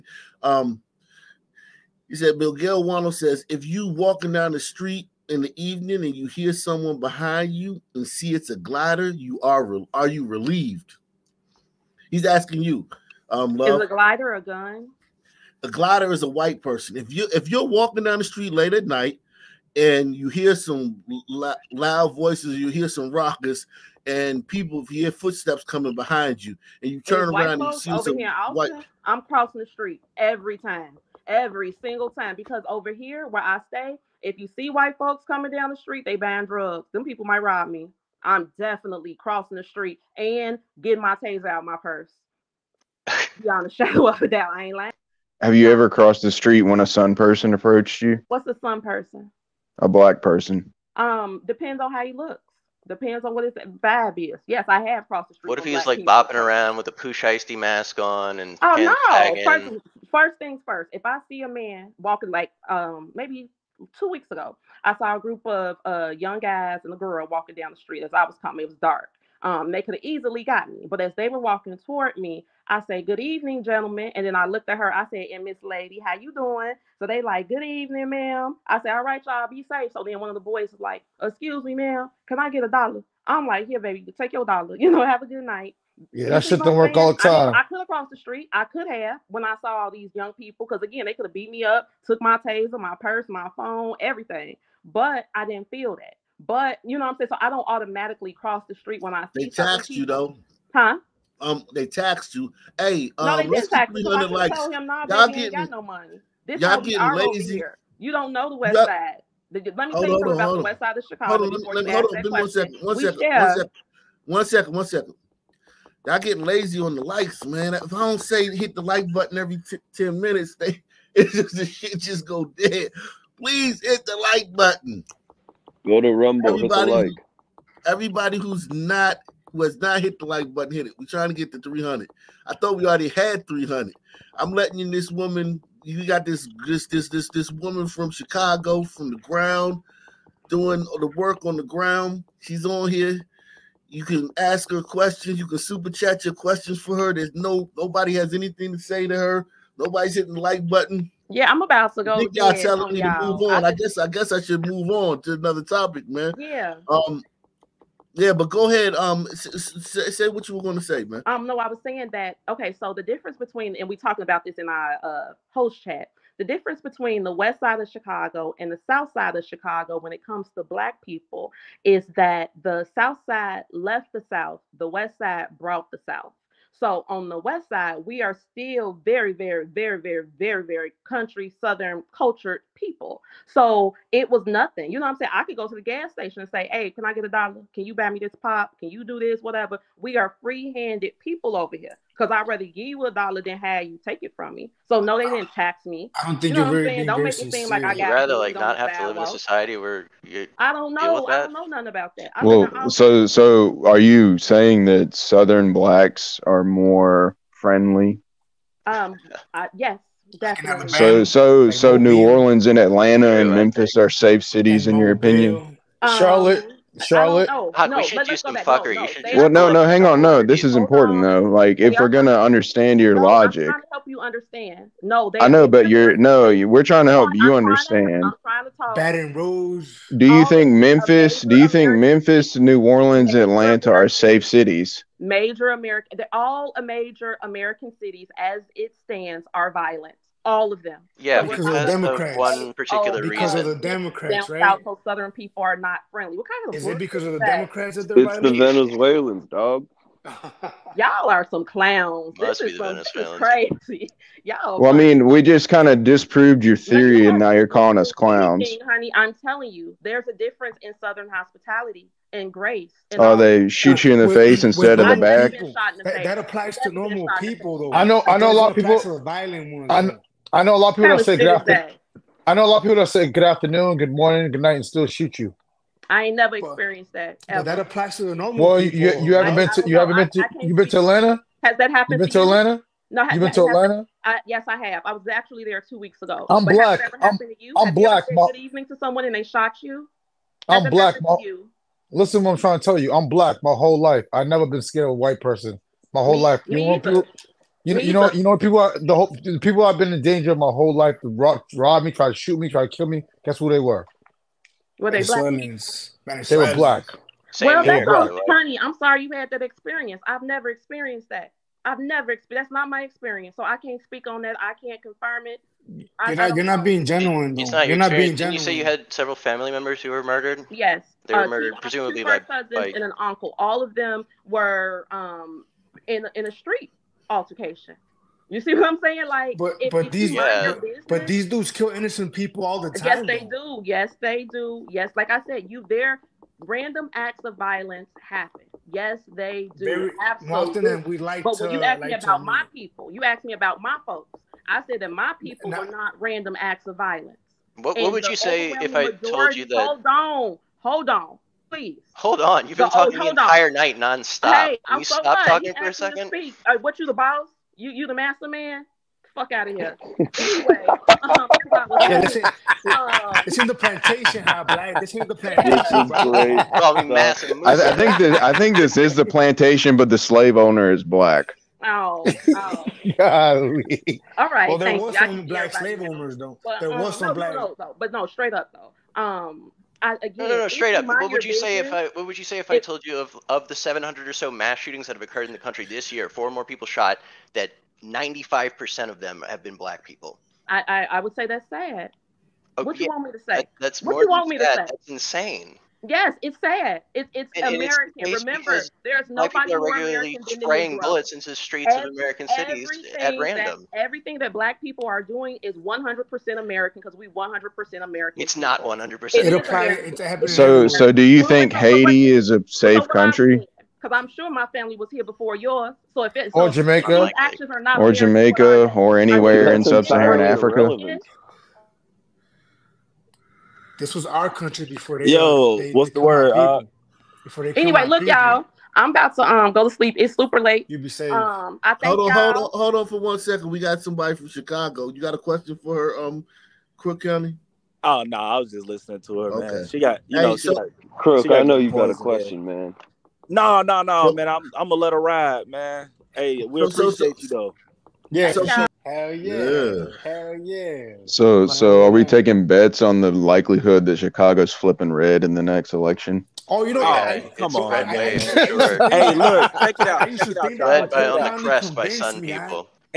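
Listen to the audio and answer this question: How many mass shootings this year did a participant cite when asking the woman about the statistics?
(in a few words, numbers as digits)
700.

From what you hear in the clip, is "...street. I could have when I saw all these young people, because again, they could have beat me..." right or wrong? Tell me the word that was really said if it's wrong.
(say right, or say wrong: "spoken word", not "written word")
right.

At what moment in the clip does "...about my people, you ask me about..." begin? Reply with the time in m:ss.
5:42.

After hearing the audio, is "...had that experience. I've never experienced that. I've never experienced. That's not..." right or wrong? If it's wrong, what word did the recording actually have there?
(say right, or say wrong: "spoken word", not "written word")
right.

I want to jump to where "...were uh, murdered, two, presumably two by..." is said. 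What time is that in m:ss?
5:21.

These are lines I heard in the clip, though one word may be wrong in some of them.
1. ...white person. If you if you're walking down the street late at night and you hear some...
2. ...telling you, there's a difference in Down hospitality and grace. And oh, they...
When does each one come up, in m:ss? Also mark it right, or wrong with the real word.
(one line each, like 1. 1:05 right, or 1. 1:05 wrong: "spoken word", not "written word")
1. 0:16 right
2. 4:19 wrong: "Southern", not "Down".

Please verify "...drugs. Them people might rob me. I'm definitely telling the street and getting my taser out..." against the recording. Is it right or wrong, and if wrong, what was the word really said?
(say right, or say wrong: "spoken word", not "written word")
wrong: "crossing", not "telling".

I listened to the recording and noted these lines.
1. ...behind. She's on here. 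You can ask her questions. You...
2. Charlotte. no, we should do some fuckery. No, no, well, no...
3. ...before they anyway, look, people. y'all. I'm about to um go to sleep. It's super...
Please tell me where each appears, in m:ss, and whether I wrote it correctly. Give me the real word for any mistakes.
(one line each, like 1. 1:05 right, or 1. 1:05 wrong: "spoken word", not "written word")
1. 2:21 wrong: "ground", not "behind"
2. 3:37 right
3. 7:07 right.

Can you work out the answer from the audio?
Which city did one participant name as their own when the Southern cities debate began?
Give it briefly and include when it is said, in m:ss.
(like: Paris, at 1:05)
Baton Rouge, at 3:48.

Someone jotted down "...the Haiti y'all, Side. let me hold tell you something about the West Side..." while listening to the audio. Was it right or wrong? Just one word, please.
wrong.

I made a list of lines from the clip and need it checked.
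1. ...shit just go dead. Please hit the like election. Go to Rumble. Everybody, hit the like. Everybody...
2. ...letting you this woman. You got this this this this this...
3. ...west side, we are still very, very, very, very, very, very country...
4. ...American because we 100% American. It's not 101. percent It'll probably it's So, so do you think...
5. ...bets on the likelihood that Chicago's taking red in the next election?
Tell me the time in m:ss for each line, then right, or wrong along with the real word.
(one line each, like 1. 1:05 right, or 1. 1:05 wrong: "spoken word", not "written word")
1. 2:01 wrong: "button", not "election"
2. 2:14 right
3. 2:57 right
4. 6:46 wrong: "100", not "101"
5. 7:32 wrong: "flipping", not "taking".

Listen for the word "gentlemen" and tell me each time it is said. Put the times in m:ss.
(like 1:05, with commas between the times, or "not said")
1:13.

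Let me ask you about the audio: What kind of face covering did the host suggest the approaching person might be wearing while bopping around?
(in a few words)
Pooh Shiesty mask.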